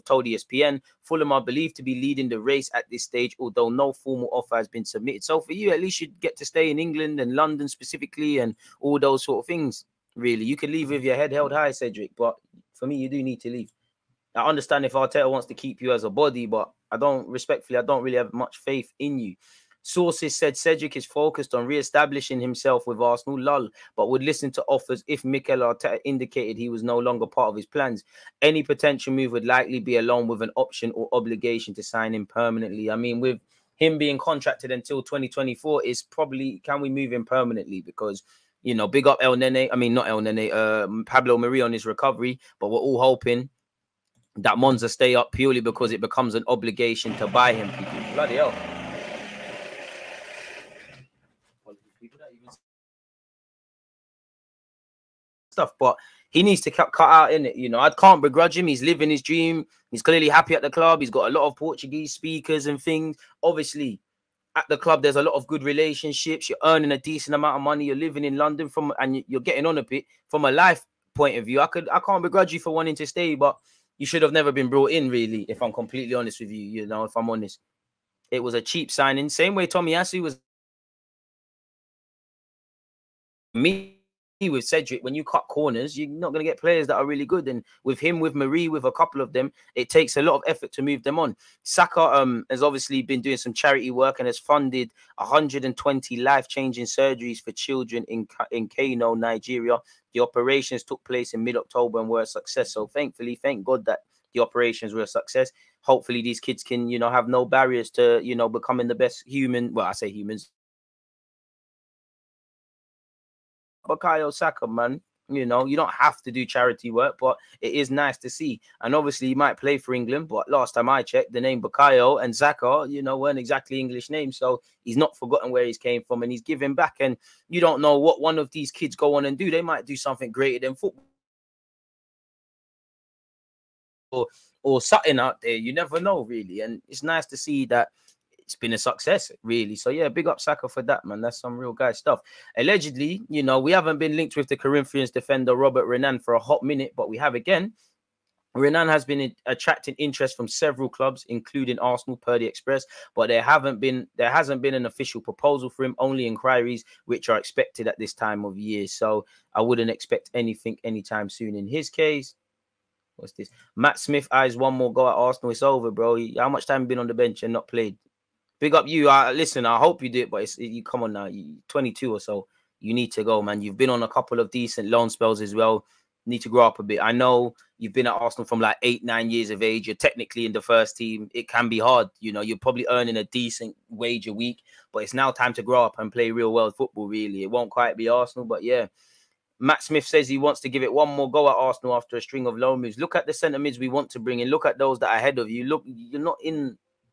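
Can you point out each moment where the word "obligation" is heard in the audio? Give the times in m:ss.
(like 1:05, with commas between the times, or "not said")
0:31, 0:46.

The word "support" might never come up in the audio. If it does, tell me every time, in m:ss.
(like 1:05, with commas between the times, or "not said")
not said.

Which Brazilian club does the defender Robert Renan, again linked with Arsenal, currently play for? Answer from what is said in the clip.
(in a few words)
Corinthians.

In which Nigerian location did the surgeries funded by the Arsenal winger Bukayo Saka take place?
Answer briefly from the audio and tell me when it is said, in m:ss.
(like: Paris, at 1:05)
Kano, at 1:38.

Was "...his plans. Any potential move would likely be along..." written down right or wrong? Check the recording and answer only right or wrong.
right.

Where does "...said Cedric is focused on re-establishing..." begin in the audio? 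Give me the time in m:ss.
0:20.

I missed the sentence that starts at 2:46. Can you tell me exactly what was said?
How much time you been on the bench and not played?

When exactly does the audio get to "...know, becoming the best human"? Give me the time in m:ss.
1:48.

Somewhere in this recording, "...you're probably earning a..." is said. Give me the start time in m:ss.
3:02.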